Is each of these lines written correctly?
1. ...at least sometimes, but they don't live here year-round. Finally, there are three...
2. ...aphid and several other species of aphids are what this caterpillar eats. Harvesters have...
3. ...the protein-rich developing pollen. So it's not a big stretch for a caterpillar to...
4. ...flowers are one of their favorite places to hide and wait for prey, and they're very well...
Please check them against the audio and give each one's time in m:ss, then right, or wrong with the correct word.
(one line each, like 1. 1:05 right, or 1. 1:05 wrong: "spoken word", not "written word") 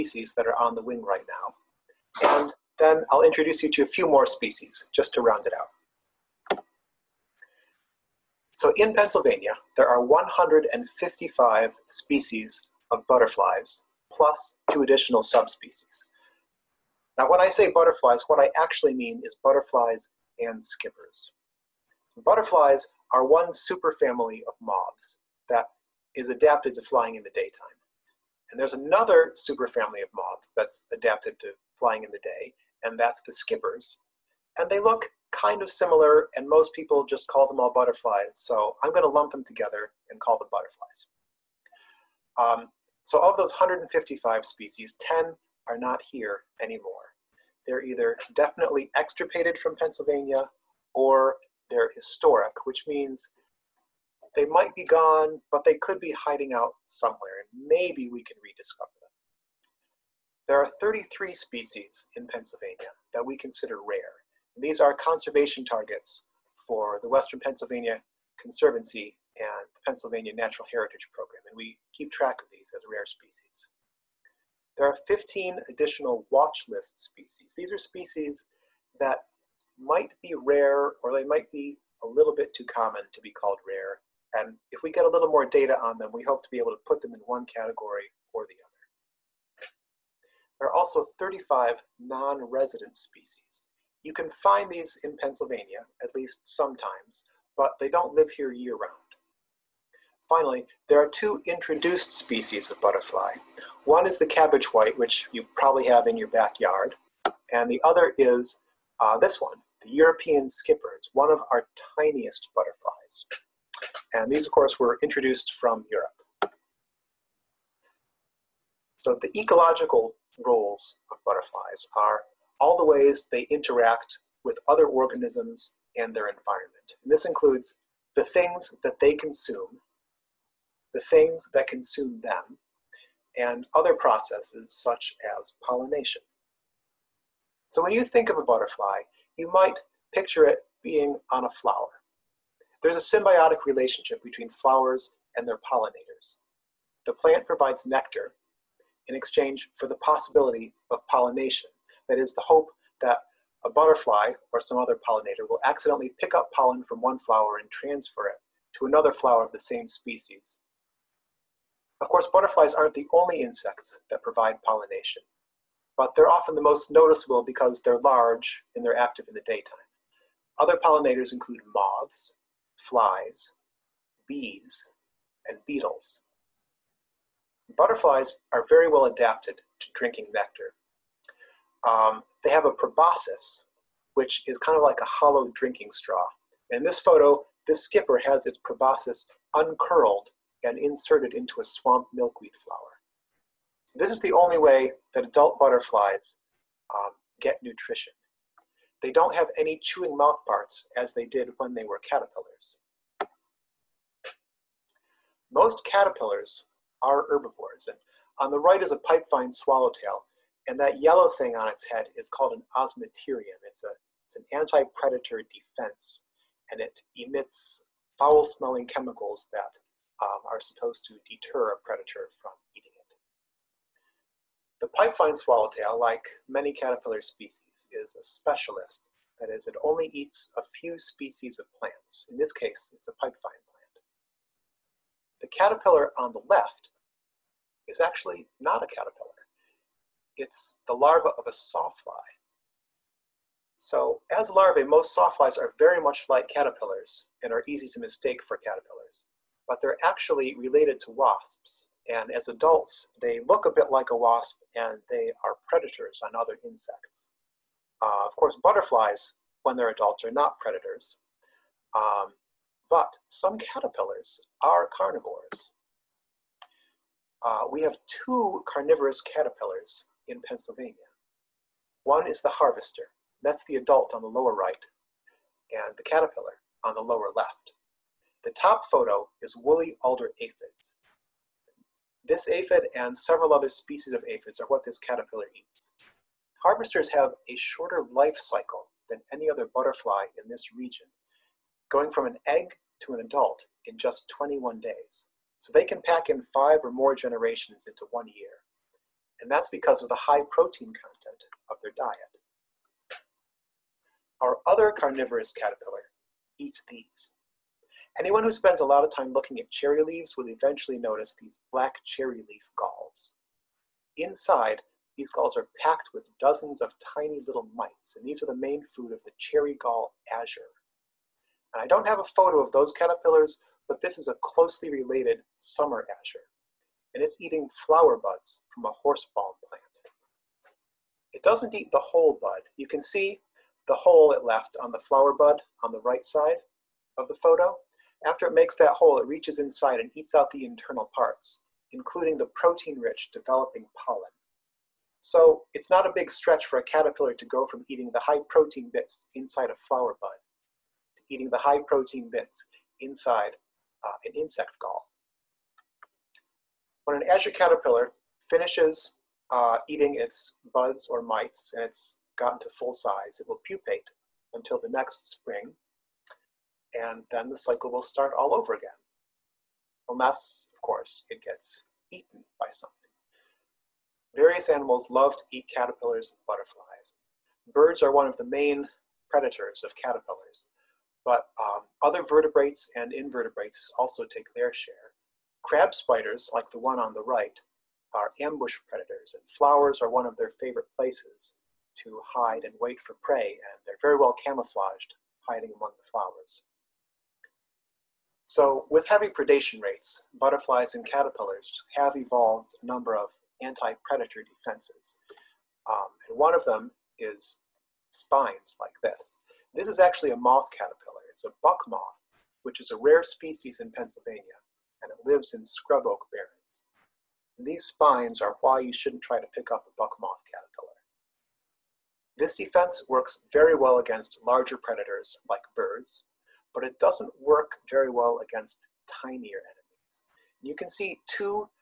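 1. 1:36 wrong: "two", not "three"
2. 4:42 right
3. 5:42 right
4. 6:29 right.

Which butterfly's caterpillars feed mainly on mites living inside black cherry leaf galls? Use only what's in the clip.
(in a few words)
Cherry gall azure.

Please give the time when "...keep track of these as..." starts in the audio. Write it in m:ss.
1:11.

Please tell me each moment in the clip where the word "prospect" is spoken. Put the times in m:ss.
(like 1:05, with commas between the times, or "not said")
not said.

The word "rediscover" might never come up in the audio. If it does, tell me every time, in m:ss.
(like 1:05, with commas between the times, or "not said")
0:58.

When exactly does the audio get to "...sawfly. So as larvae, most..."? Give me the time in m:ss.
4:01.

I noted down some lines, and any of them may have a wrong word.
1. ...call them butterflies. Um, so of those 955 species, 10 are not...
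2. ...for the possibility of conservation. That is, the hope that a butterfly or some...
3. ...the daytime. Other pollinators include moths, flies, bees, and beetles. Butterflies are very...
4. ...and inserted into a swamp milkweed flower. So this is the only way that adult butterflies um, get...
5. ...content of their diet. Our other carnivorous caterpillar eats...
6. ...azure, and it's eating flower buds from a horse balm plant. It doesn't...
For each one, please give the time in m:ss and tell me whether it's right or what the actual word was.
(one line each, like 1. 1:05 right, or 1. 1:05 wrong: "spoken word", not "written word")
1. 0:40 wrong: "155", not "955"
2. 2:29 wrong: "pollination", not "conservation"
3. 2:49 right
4. 3:10 right
5. 5:00 right
6. 5:26 right.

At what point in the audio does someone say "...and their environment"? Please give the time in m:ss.
2:05.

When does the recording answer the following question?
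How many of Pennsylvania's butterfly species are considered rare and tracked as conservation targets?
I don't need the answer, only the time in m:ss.
1:00.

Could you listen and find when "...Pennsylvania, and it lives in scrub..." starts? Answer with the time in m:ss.
6:53.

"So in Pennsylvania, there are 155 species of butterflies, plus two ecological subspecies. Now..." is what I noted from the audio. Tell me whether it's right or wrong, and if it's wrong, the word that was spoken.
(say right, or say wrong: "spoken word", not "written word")
wrong: "additional", not "ecological".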